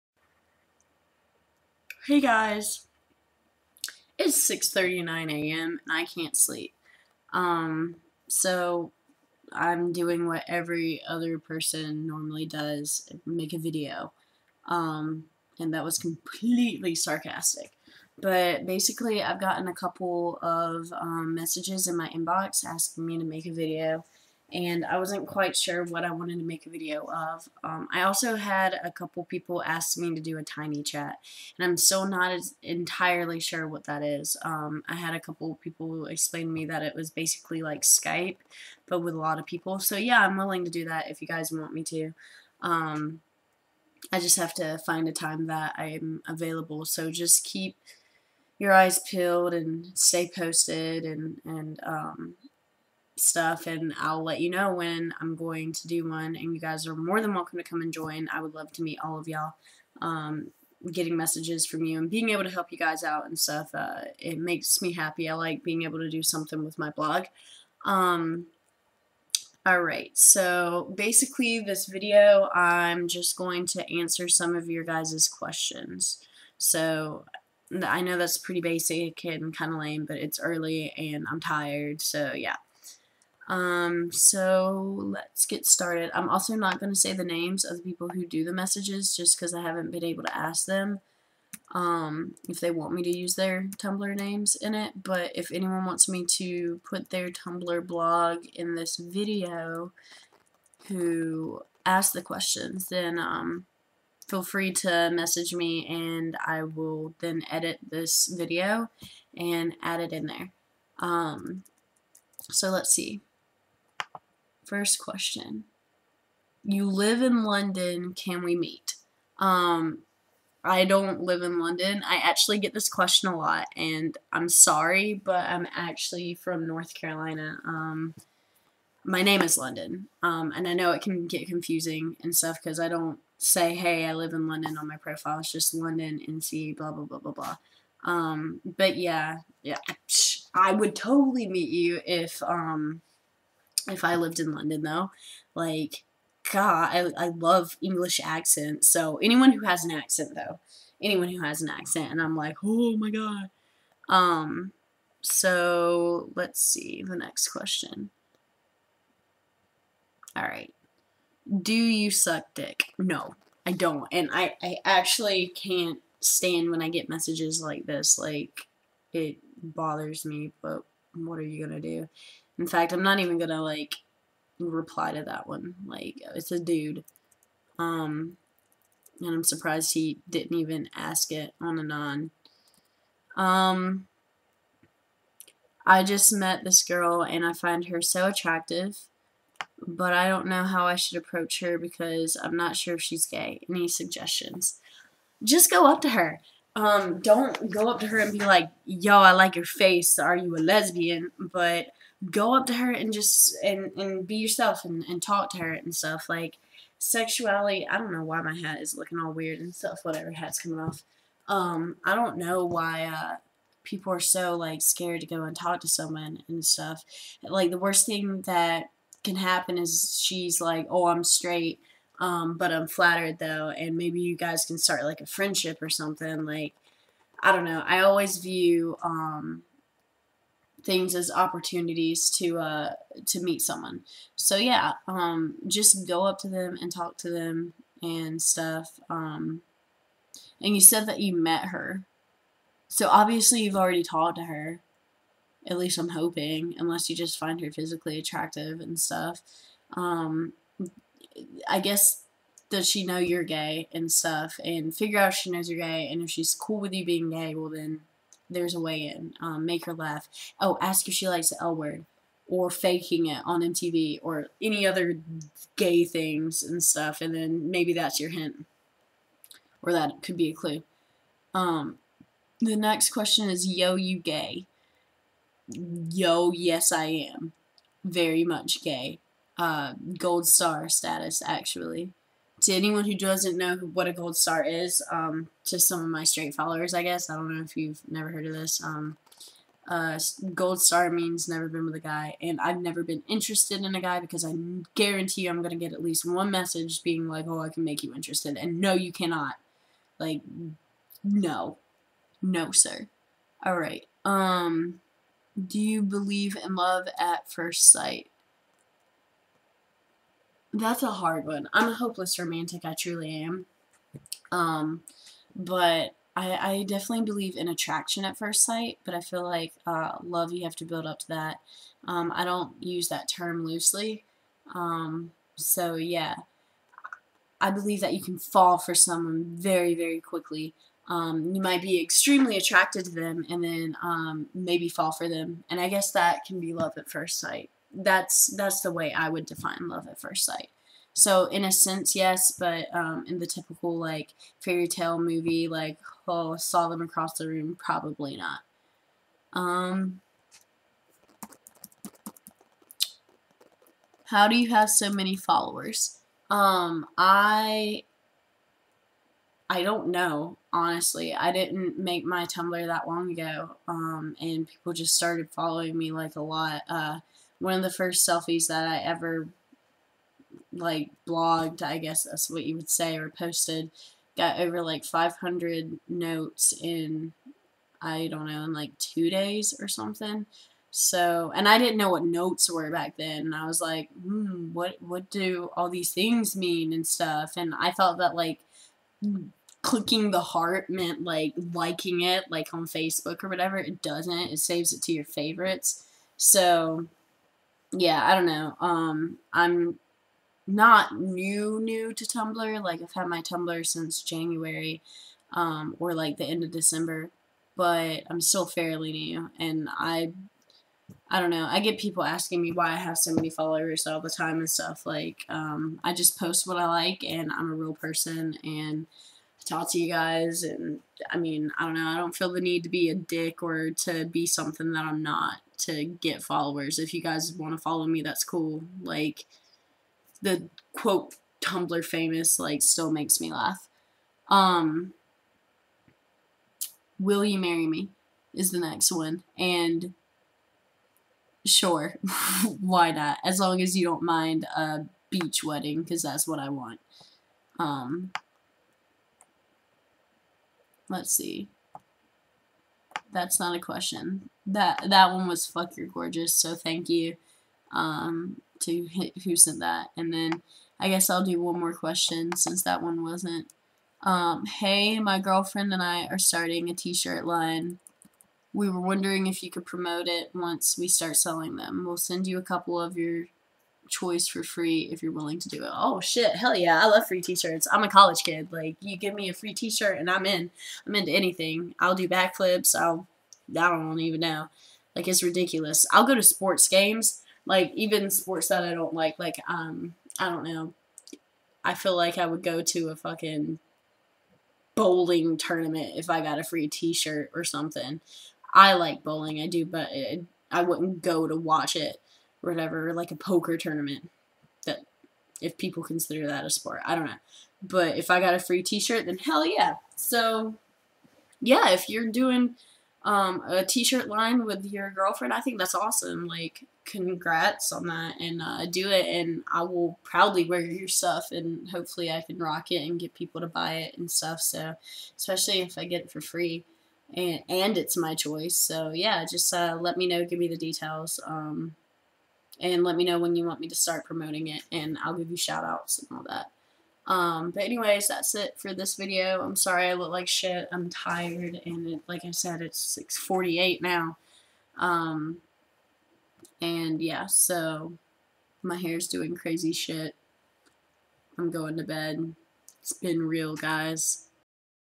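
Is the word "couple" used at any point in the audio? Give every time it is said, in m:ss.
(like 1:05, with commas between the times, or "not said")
0:19, 0:28, 0:35, 7:52.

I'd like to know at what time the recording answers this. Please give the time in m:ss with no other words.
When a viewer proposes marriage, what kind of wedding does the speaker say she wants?
7:25.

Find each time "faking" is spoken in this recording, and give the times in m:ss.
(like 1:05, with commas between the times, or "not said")
4:22.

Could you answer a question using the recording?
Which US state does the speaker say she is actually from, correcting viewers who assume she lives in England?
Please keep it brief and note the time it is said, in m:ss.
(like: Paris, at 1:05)
North Carolina, at 2:06.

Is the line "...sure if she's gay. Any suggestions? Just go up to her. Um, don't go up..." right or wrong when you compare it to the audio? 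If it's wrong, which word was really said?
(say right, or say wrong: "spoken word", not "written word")
right.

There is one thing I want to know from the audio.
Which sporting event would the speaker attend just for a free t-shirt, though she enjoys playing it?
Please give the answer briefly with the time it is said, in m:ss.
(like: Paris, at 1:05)
bowling tournament, at 8:14.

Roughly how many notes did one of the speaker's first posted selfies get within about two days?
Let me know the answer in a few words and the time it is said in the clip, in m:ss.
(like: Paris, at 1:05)
500, at 6:15.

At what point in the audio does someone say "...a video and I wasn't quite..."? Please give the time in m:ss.
0:23.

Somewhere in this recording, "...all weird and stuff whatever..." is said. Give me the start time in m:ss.
3:29.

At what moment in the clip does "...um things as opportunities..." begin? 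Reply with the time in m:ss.
3:49.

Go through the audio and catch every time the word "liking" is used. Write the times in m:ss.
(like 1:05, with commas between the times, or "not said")
6:31.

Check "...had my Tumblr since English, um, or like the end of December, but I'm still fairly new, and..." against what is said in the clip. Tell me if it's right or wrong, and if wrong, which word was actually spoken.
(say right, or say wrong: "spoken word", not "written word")
wrong: "January", not "English".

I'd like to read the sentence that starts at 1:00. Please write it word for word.
Um, getting messages from you and being able to help you guys out and stuff, uh, it makes me happy.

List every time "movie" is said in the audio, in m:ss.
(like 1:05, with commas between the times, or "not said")
5:45.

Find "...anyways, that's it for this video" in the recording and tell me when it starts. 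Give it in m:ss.
8:57.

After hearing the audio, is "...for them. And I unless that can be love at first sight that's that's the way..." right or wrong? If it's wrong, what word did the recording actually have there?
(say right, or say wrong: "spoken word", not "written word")
wrong: "guess", not "unless".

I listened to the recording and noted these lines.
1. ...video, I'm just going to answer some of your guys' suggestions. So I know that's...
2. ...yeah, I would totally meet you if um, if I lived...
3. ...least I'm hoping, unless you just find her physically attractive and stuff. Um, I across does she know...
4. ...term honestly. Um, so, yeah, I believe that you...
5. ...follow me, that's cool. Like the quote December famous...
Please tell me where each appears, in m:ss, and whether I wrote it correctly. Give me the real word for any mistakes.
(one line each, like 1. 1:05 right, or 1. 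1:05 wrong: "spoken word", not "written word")
1. 1:11 wrong: "questions", not "suggestions"
2. 2:19 right
3. 4:05 wrong: "guess", not "across"
4. 5:23 wrong: "loosely", not "honestly"
5. 7:07 wrong: "Tumblr", not "December".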